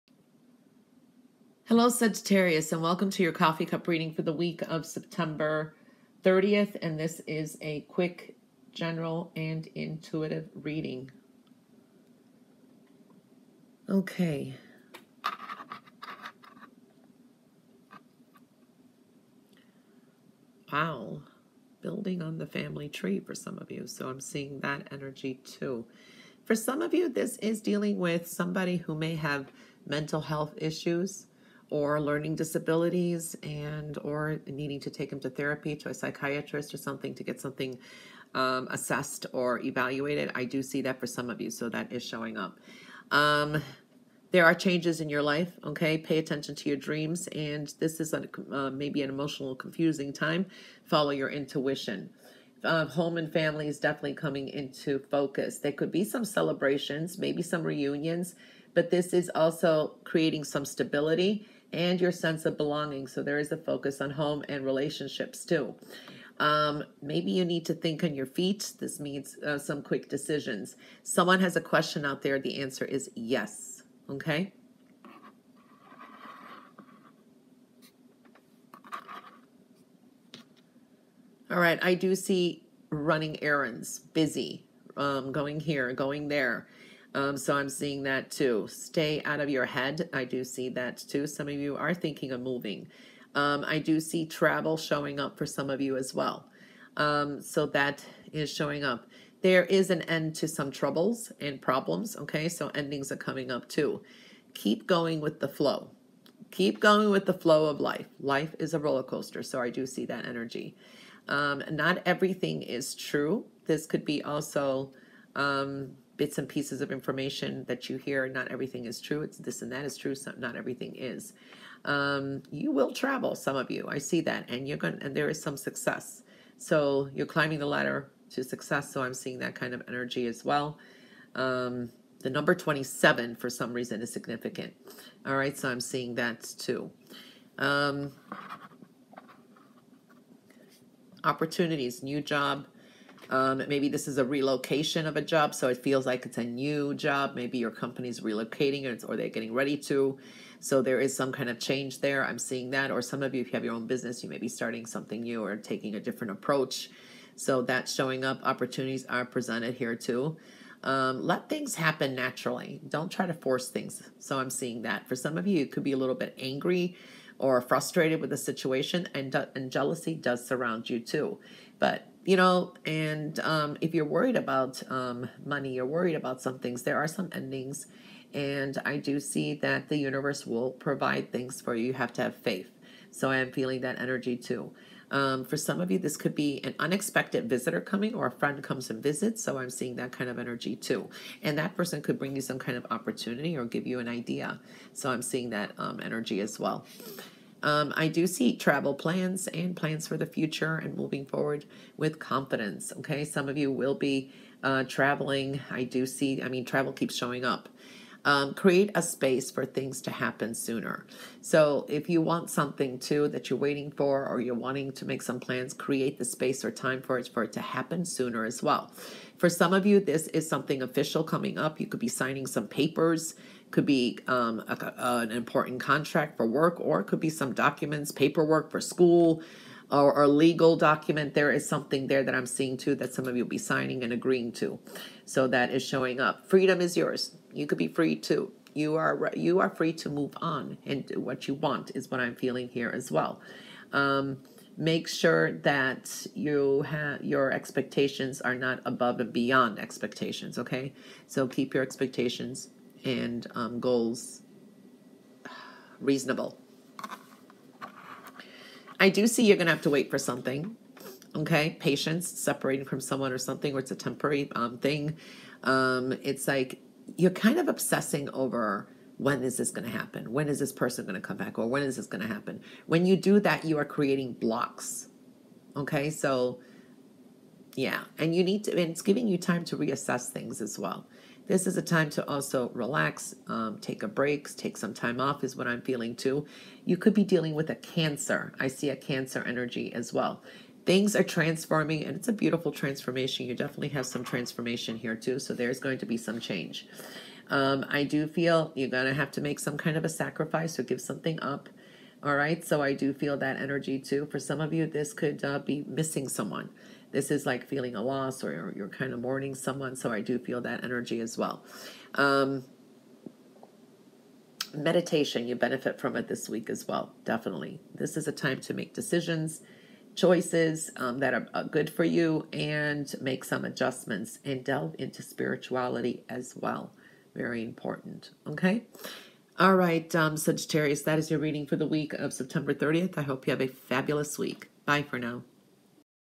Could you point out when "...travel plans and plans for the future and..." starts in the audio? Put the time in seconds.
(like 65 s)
198 s.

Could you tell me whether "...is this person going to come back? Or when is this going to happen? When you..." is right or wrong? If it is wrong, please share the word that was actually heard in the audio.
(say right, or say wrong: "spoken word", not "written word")
right.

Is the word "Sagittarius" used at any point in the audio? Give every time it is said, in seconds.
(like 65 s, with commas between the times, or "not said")
1 s, 330 s.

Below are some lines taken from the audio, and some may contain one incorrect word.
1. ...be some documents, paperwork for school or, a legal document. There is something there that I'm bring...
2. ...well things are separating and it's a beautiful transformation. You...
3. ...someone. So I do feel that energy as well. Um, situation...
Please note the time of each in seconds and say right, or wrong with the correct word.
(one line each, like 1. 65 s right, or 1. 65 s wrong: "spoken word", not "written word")
1. 227 s wrong: "seeing", not "bring"
2. 290 s wrong: "transforming", not "separating"
3. 309 s wrong: "meditation", not "situation".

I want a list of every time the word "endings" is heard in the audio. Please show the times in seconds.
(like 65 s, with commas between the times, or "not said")
102 s, 177 s.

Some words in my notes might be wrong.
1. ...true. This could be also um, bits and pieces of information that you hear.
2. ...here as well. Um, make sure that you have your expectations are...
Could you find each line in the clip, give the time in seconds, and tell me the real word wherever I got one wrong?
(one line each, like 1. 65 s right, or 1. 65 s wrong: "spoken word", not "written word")
1. 112 s right
2. 242 s right.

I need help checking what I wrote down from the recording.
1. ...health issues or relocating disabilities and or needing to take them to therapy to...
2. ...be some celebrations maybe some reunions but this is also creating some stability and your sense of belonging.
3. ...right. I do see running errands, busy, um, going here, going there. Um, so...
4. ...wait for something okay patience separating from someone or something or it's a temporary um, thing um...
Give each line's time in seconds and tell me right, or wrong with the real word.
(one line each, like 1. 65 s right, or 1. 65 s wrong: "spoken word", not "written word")
1. 30 s wrong: "learning", not "relocating"
2. 55 s right
3. 81 s right
4. 259 s right.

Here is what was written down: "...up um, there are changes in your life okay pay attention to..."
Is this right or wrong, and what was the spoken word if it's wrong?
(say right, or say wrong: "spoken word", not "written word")
right.